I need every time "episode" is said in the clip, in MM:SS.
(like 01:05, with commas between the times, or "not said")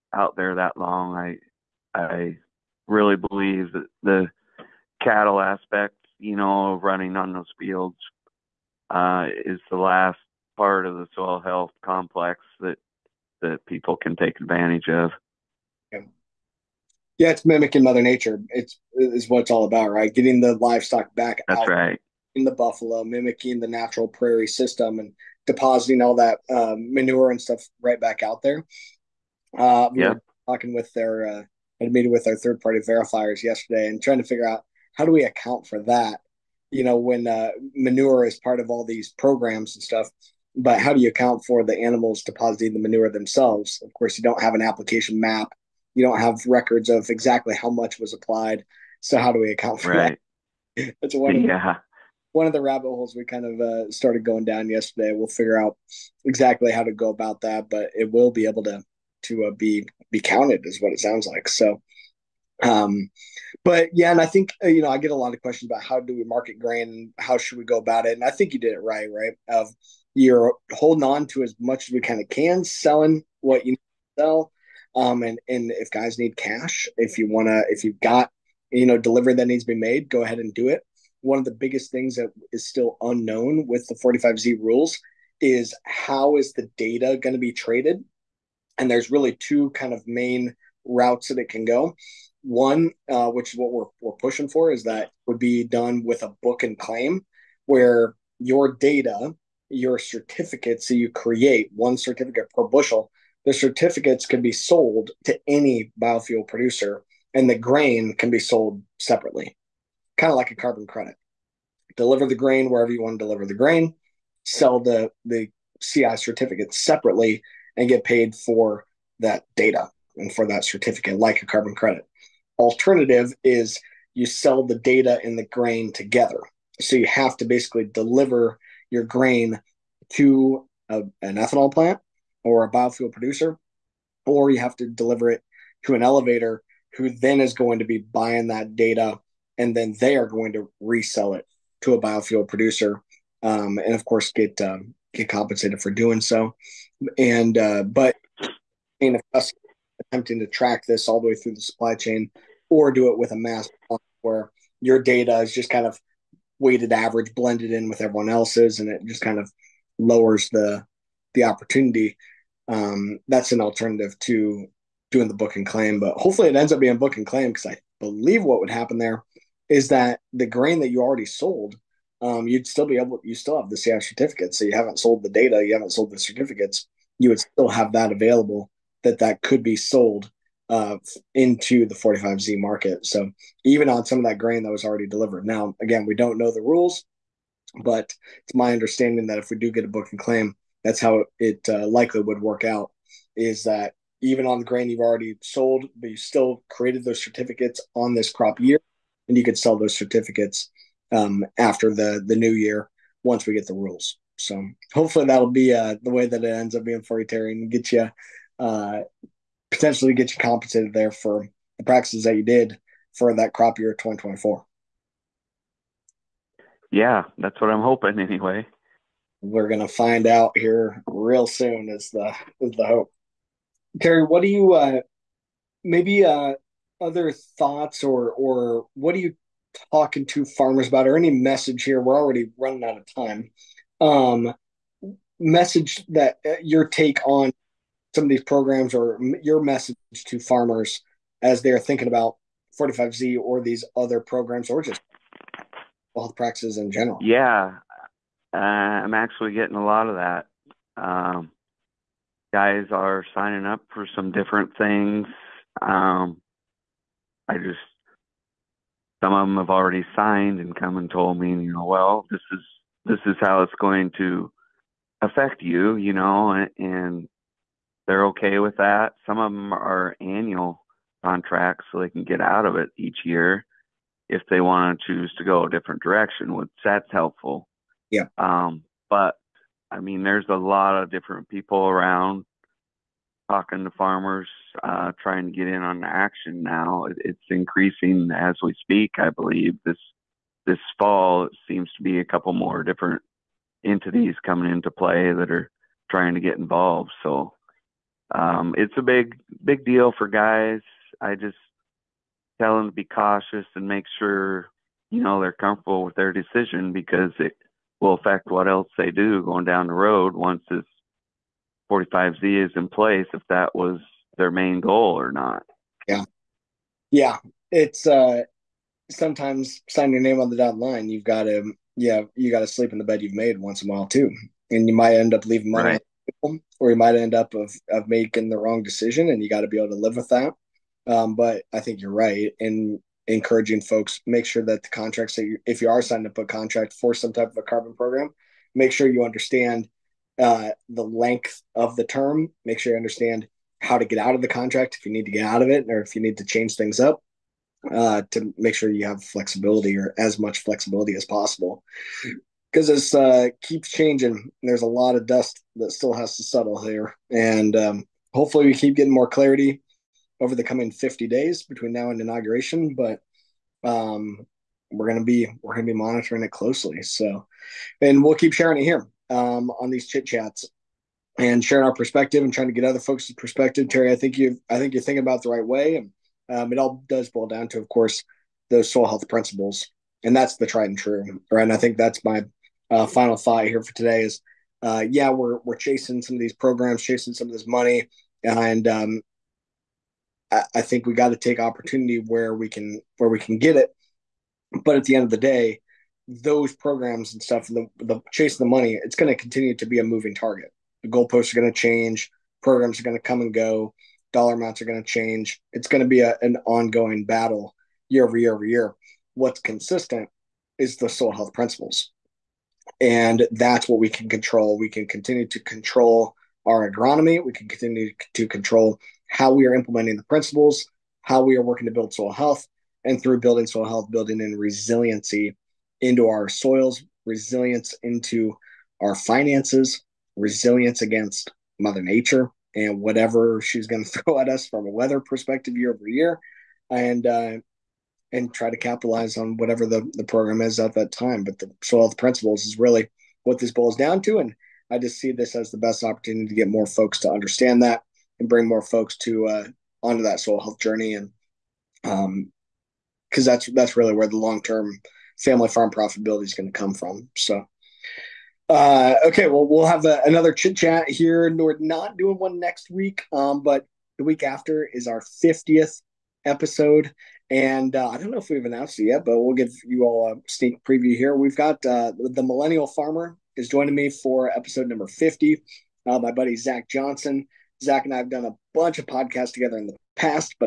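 07:46, 07:54.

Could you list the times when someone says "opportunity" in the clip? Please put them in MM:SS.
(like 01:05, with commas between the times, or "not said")
02:41, 06:31, 07:26.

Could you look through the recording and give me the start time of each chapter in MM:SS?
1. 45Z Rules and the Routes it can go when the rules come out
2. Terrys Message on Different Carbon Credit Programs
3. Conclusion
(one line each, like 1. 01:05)
1. 01:23
2. 03:50
3. 07:37.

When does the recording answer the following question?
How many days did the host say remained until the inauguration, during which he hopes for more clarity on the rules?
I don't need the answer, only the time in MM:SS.
06:00.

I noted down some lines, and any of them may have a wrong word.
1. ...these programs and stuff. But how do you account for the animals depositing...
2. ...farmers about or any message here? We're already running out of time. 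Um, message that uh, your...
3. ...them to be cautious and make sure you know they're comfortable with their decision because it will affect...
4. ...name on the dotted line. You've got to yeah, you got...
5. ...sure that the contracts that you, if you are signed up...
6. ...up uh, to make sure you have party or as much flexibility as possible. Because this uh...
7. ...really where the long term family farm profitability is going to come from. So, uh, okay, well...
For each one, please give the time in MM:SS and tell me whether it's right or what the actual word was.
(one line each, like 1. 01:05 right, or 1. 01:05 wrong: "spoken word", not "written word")
1. 00:38 right
2. 03:50 right
3. 05:02 right
4. 05:20 right
5. 05:34 right
6. 05:46 wrong: "flexibility", not "party"
7. 07:33 right.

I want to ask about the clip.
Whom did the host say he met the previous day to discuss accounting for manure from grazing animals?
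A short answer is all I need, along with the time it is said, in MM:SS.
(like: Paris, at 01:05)
third party verifiers, at 00:32.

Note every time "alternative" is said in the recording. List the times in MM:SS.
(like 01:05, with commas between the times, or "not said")
02:02, 02:43.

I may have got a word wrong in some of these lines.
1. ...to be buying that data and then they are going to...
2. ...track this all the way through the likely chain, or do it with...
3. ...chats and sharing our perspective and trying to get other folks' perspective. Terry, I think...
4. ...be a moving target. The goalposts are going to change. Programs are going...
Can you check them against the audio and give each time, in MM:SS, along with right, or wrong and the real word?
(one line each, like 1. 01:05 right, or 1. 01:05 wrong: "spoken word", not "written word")
1. 02:17 right
2. 02:30 wrong: "supply", not "likely"
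3. 06:10 right
4. 06:39 right.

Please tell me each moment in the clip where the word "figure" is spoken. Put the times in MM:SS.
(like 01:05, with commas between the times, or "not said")
00:34, 00:55.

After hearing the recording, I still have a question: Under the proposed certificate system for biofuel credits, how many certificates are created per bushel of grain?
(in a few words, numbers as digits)
1.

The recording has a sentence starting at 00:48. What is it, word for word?
So how do we account for right.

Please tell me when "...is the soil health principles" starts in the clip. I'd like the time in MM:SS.
06:50.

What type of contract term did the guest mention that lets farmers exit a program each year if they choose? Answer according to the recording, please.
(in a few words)
annual contracts.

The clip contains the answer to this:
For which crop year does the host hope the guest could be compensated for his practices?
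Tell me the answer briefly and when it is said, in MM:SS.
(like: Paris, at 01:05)
2024, at 03:33.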